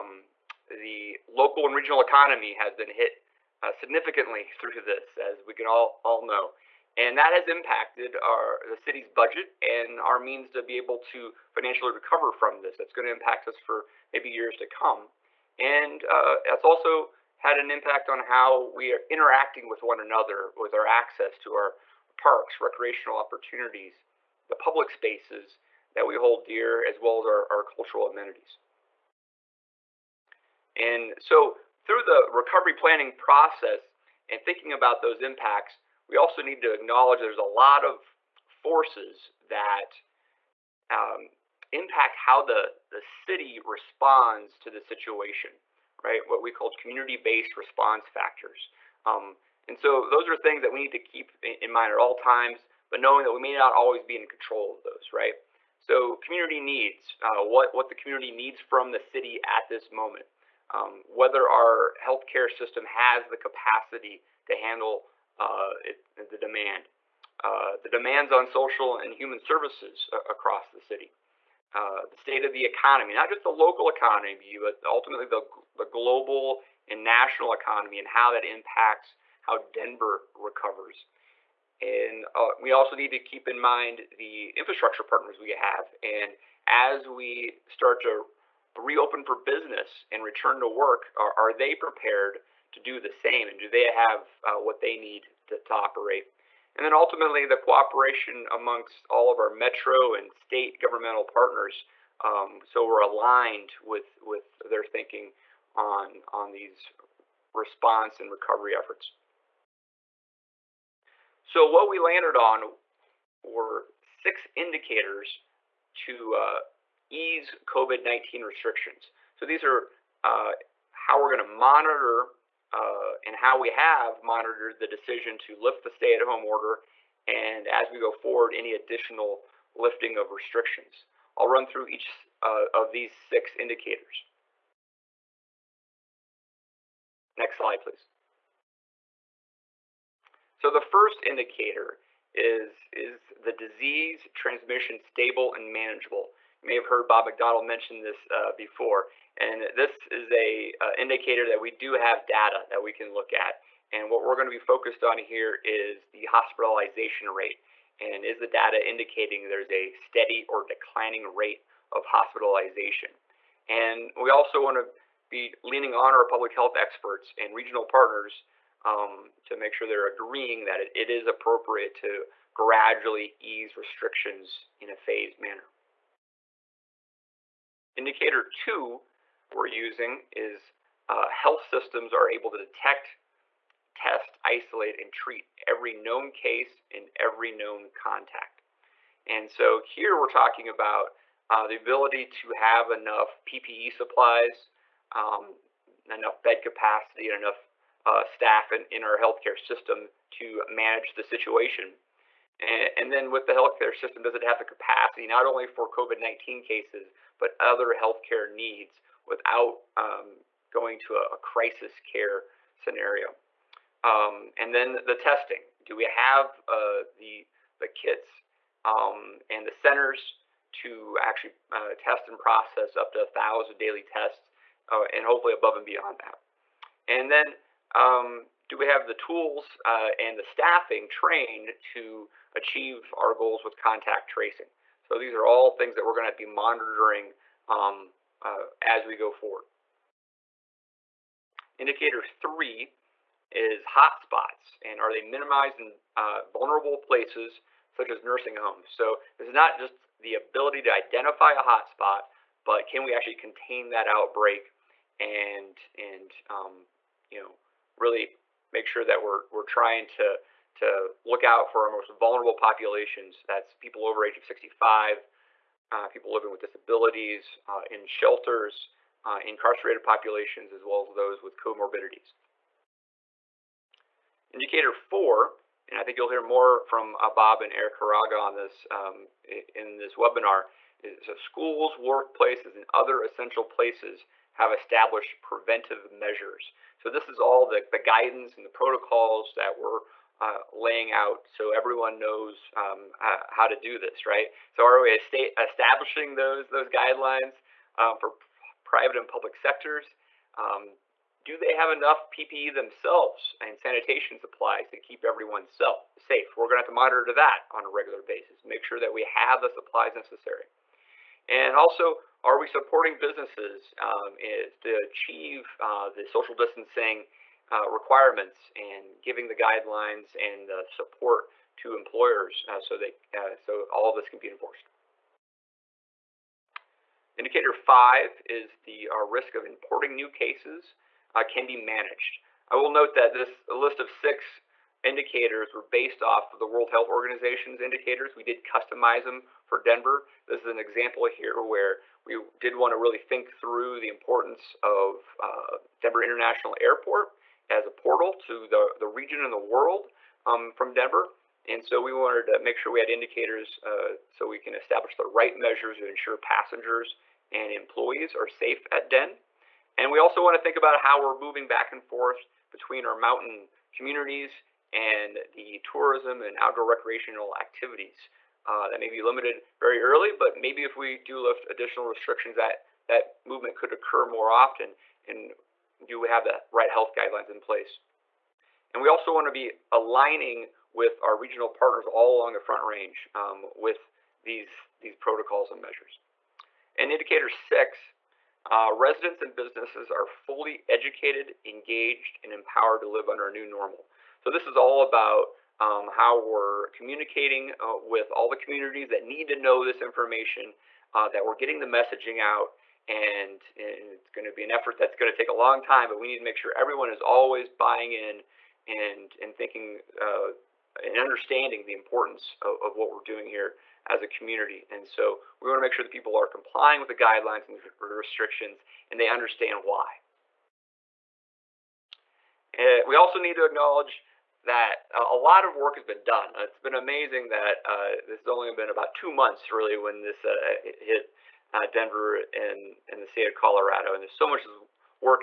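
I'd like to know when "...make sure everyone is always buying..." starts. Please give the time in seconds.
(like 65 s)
406 s.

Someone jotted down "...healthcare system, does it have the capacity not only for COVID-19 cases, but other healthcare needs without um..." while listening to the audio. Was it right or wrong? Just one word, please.
right.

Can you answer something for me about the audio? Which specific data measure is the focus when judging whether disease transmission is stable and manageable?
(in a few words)
hospitalization rate.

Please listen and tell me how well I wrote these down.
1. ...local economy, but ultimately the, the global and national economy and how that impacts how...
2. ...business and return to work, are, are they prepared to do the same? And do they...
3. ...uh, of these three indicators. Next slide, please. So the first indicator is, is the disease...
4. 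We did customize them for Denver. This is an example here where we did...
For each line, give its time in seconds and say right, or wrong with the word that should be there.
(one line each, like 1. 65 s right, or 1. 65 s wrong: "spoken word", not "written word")
1. 73 s right
2. 89 s right
3. 132 s wrong: "six", not "three"
4. 338 s right.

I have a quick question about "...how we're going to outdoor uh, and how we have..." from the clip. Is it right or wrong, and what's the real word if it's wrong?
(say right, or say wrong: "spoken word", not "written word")
wrong: "monitor", not "outdoor".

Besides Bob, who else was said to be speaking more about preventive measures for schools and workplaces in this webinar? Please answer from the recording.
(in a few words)
Eric Hiraga.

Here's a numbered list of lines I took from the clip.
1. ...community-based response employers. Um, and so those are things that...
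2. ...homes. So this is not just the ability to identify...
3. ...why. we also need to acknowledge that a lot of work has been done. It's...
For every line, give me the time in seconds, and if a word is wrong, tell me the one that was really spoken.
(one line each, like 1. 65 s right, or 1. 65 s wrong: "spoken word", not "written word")
1. 46 s wrong: "factors", not "employers"
2. 248 s right
3. 419 s right.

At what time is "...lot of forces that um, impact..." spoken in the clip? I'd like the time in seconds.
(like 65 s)
37 s.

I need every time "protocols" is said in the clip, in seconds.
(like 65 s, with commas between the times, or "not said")
288 s, 385 s.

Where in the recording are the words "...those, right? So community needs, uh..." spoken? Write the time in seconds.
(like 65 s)
54 s.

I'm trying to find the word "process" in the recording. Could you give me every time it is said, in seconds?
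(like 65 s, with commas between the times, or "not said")
33 s, 222 s.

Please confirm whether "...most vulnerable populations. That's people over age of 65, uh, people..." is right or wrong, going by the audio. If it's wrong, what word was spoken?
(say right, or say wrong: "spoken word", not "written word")
right.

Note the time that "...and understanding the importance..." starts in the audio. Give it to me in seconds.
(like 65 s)
411 s.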